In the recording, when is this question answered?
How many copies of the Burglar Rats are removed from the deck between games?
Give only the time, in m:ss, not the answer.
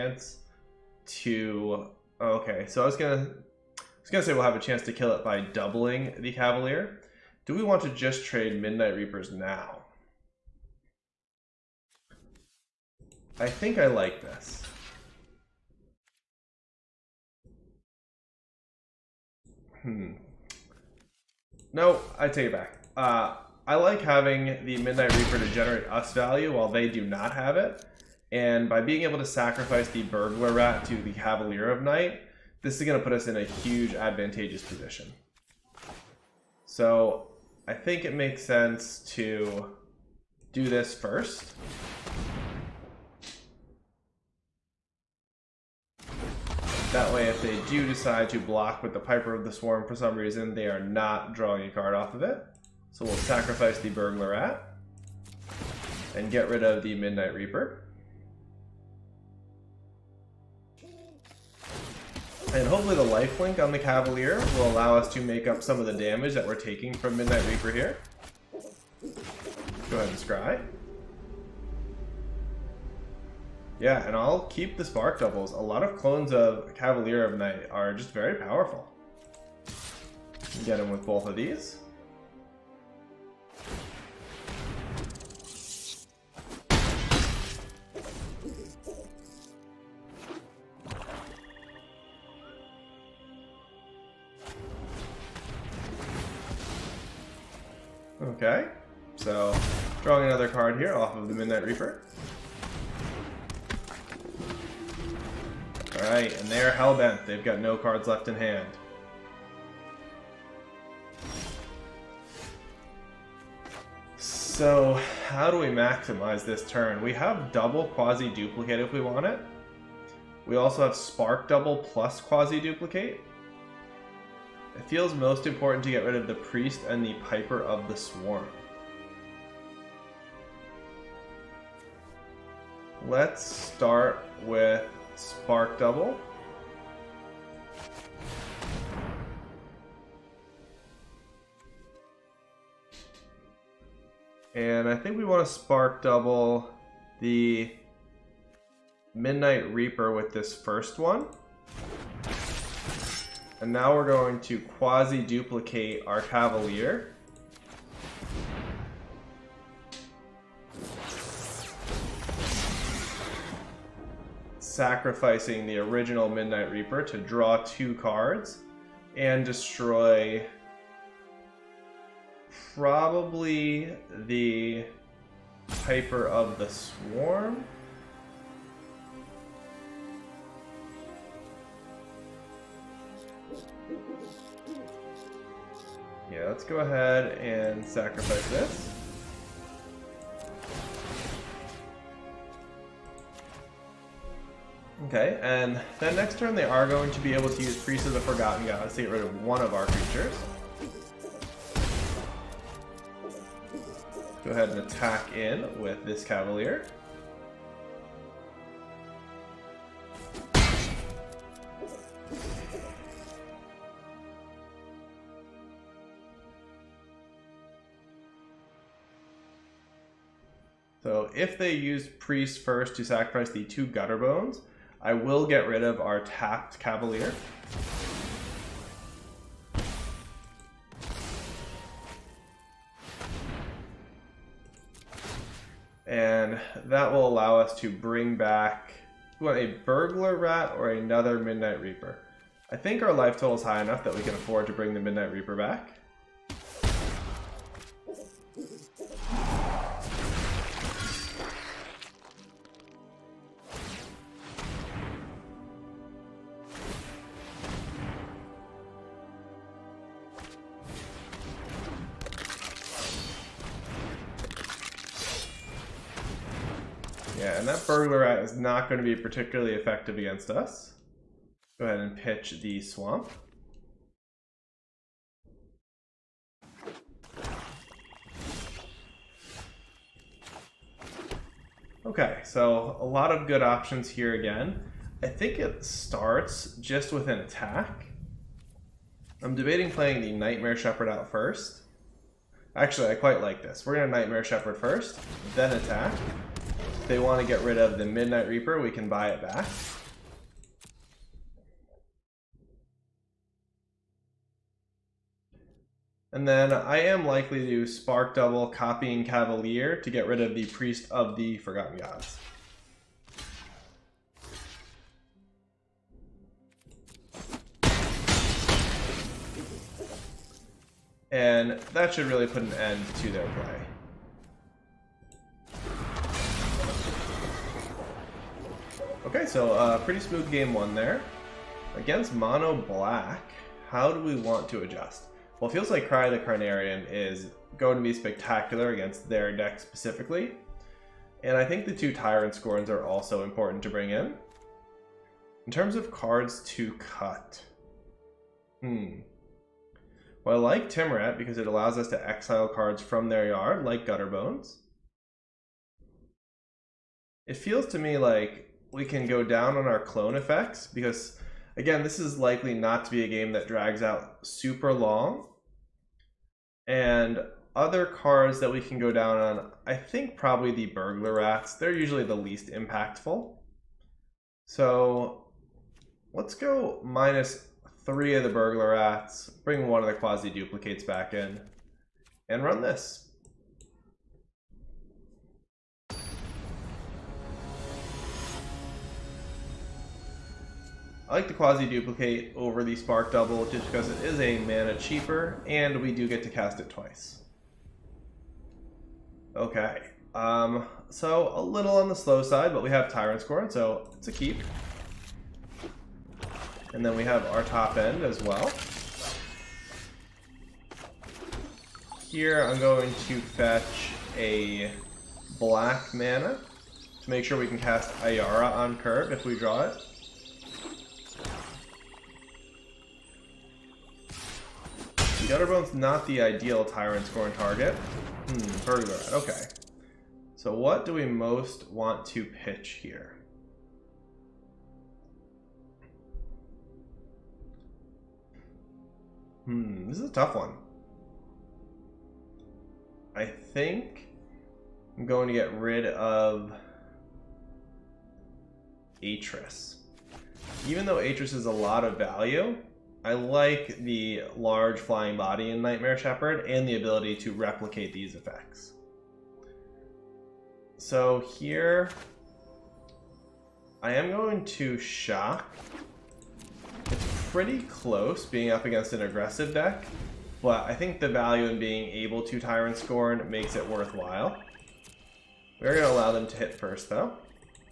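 6:18.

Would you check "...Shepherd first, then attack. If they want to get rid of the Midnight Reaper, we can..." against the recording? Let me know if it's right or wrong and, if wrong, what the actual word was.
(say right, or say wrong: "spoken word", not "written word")
right.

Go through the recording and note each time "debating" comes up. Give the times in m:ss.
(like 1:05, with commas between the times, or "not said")
4:49.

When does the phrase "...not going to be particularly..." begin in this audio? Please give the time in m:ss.
4:28.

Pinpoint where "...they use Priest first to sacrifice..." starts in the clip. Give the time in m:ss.
3:41.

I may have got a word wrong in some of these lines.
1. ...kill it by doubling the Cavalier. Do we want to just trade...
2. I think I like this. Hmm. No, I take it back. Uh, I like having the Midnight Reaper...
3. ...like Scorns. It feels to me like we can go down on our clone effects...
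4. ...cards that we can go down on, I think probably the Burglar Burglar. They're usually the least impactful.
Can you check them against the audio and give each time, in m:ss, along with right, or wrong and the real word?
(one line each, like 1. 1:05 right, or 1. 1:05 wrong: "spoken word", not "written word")
1. 0:04 right
2. 0:13 right
3. 5:53 wrong: "Gutterbones", not "Scorns"
4. 6:08 wrong: "Rats", not "Burglar".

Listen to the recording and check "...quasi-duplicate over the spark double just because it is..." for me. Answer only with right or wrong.
right.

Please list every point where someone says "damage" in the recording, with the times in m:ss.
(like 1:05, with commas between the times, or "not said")
1:05.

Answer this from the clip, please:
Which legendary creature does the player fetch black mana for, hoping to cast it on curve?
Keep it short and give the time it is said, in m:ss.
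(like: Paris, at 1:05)
Ayara, at 6:58.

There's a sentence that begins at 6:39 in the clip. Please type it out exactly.
Okay, um, so a little on the slow side, but we have Tyrant's Scorn, so it's a keep.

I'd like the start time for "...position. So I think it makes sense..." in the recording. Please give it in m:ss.
0:34.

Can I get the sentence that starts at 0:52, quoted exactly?
So we'll sacrifice the Burglar Rat and get rid of the Midnight Reaper.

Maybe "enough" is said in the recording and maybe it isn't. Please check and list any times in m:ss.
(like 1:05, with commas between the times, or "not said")
4:03.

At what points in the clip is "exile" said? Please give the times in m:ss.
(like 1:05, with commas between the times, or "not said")
5:52.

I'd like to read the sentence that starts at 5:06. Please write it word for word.
And then I am likely to Spark Double Copying Cavalier to get rid of the Priest of the Forgotten Gods.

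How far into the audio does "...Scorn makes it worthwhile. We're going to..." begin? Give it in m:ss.
7:52.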